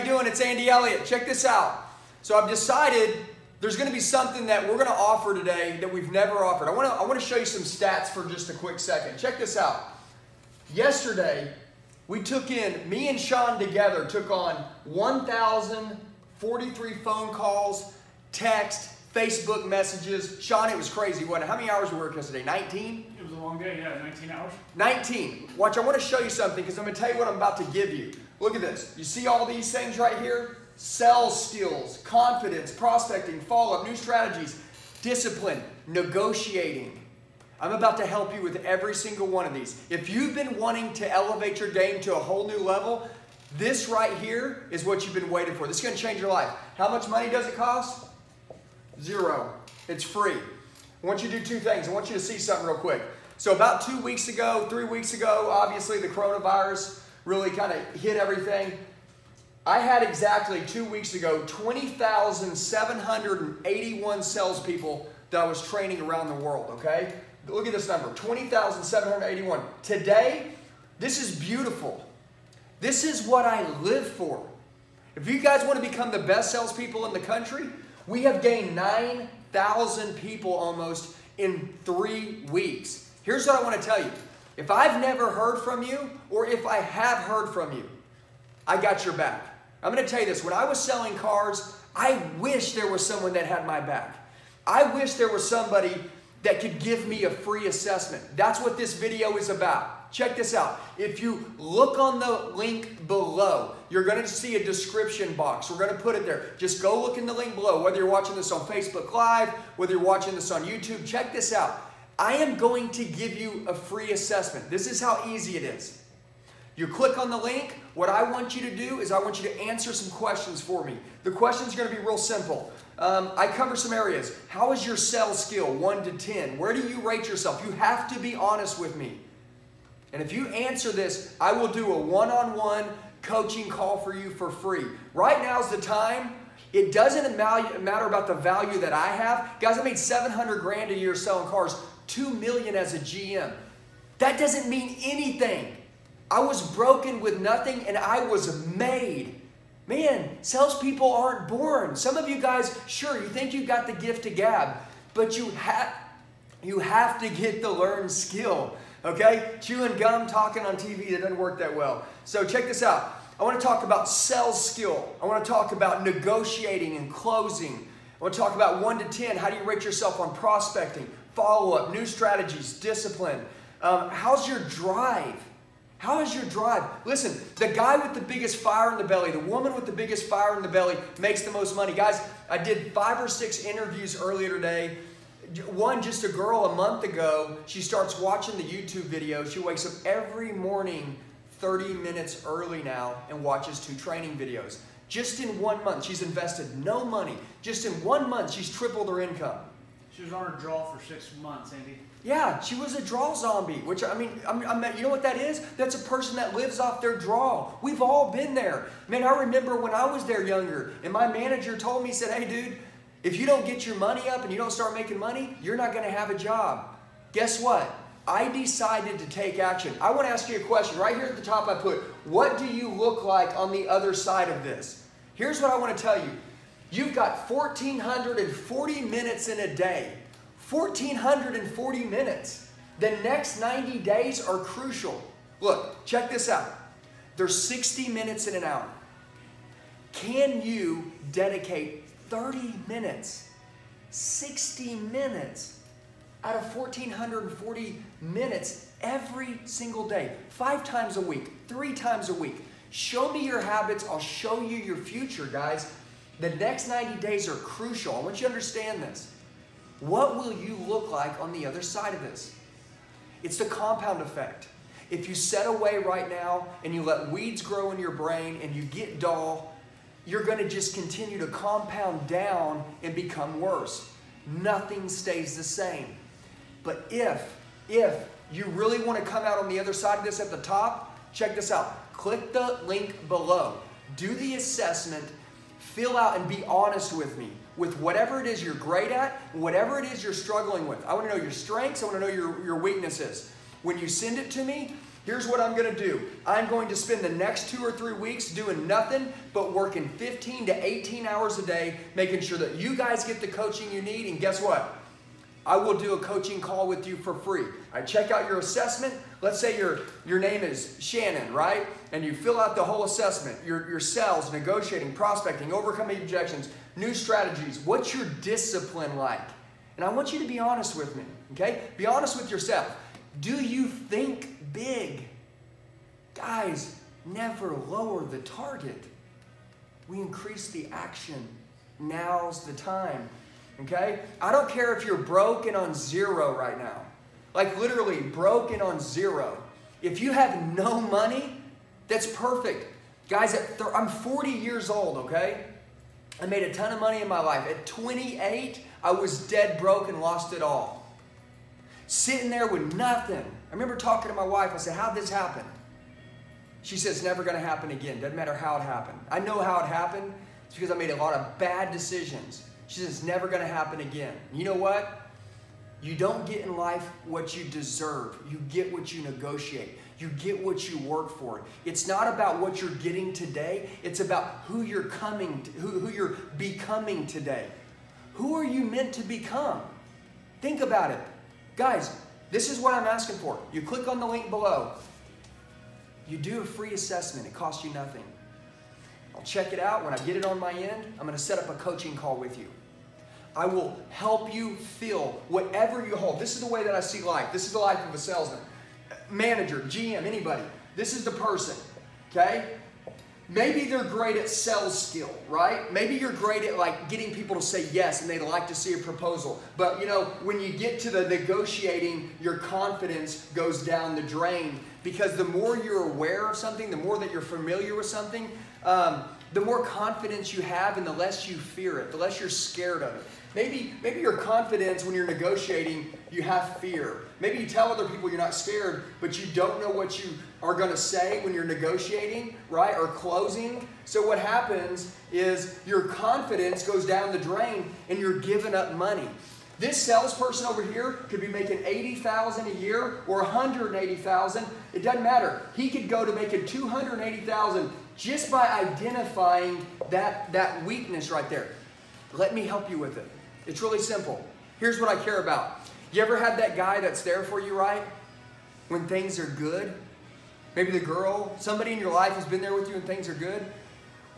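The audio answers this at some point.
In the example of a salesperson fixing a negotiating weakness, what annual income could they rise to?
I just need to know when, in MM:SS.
07:26.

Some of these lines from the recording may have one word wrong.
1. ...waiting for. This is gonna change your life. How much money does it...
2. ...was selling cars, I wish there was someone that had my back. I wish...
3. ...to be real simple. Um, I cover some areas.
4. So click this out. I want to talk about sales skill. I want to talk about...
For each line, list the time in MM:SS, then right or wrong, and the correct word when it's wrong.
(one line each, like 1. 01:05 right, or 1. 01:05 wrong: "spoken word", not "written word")
1. 00:45 right
2. 01:30 right
3. 02:01 right
4. 02:42 wrong: "check", not "click".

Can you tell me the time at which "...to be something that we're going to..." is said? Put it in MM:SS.
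00:03.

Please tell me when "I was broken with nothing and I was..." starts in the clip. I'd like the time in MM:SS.
02:26.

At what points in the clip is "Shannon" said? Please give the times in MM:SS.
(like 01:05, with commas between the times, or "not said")
05:10.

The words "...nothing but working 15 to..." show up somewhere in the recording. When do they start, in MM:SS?
04:58.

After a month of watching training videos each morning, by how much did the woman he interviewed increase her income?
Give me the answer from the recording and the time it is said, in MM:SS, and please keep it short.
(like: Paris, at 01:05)
tripled, at 03:18.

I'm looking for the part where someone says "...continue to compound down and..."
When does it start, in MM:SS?
04:30.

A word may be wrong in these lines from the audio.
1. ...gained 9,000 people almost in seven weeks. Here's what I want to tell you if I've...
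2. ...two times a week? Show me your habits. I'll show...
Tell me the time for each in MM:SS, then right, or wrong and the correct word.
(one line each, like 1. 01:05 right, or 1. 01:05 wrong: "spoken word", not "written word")
1. 01:18 wrong: "three", not "seven"
2. 04:11 wrong: "three", not "two".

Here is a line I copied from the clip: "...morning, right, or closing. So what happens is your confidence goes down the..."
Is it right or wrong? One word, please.
wrong.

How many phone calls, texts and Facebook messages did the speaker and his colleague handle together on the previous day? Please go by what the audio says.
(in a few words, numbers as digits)
1,043.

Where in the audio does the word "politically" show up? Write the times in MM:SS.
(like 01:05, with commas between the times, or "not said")
not said.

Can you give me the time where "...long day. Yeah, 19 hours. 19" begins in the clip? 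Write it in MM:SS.
00:23.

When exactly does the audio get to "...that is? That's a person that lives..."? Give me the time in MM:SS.
03:25.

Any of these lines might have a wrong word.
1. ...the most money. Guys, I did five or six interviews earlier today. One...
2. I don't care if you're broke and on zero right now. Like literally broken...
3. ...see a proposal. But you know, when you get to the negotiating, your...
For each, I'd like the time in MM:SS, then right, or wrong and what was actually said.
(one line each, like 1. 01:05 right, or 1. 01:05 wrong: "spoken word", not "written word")
1. 03:01 right
2. 05:34 right
3. 06:48 right.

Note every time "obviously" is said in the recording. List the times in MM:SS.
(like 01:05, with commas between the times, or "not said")
00:55.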